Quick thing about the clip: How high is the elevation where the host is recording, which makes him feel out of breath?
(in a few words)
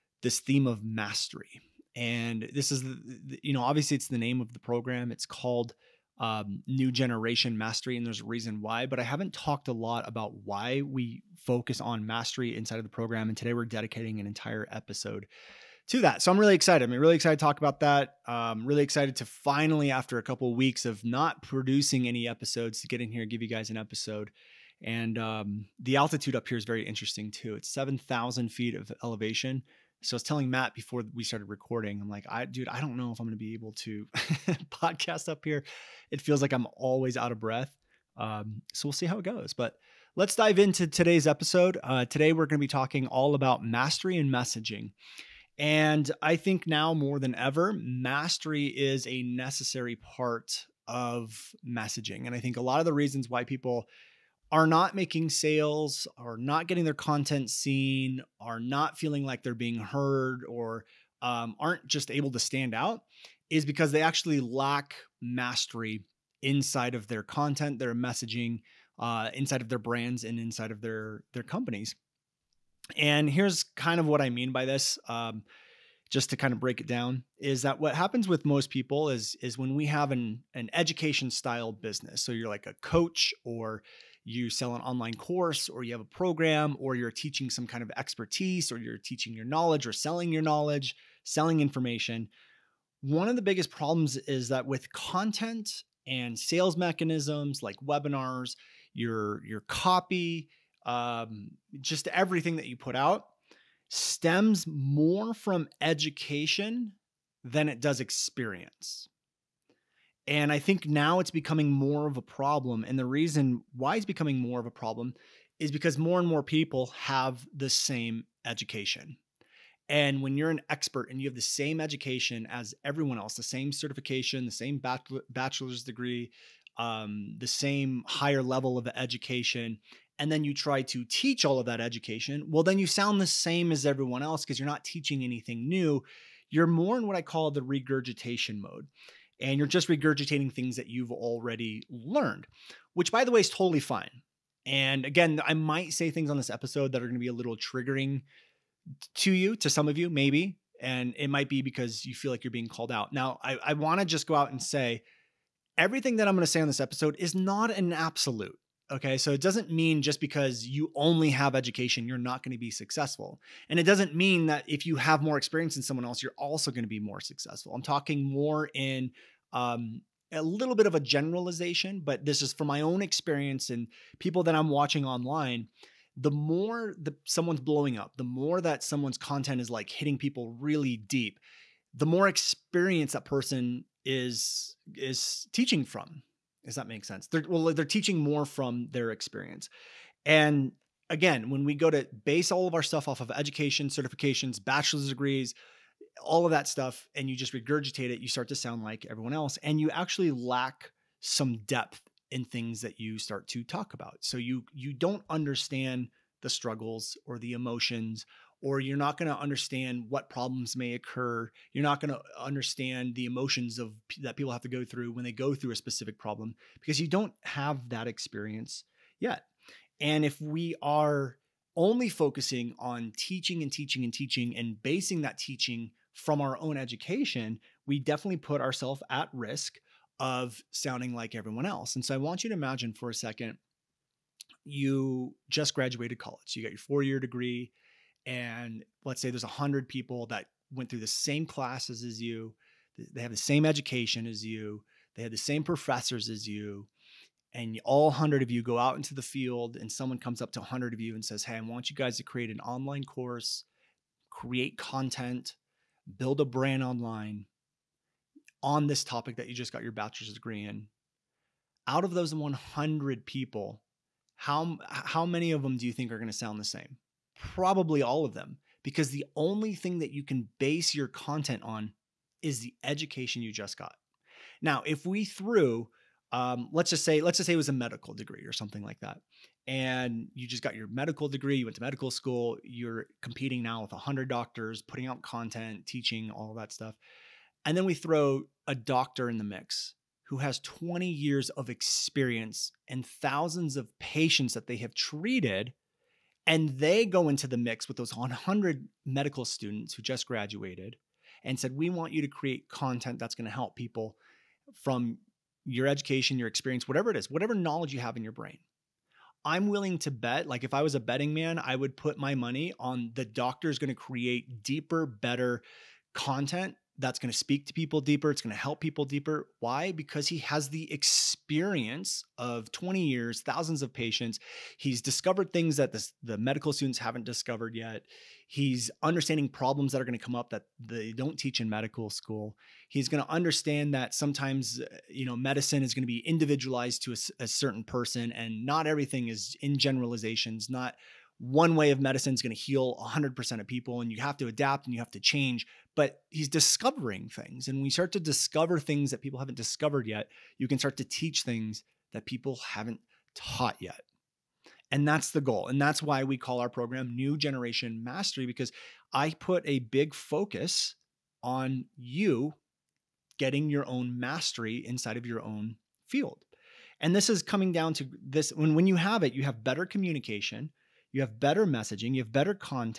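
7,000 feet.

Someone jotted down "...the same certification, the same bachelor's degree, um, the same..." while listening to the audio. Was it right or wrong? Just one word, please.
right.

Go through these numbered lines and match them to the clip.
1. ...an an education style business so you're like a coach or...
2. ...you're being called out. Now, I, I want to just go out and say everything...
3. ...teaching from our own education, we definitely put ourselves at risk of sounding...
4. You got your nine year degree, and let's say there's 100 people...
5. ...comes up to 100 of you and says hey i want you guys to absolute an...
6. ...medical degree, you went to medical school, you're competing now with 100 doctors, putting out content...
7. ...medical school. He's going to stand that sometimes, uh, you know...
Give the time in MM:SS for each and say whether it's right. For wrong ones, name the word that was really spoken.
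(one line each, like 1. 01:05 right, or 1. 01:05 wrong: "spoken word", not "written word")
1. 01:20 right
2. 02:32 right
3. 03:45 right
4. 03:56 wrong: "four", not "nine"
5. 04:10 wrong: "create", not "absolute"
6. 04:40 right
7. 05:31 wrong: "understand", not "stand".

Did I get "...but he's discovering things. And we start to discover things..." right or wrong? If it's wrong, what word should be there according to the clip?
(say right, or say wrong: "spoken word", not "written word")
right.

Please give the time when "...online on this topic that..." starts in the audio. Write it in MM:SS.
04:16.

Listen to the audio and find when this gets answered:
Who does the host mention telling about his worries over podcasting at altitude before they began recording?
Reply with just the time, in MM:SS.
00:30.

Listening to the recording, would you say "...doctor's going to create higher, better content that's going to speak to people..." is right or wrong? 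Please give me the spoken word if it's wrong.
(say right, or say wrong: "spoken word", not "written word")
wrong: "deeper", not "higher".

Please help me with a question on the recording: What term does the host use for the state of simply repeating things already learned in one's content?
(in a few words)
regurgitation mode.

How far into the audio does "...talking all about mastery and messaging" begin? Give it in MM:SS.
00:42.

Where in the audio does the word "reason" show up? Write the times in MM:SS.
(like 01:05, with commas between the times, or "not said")
00:08, 00:52, 01:53.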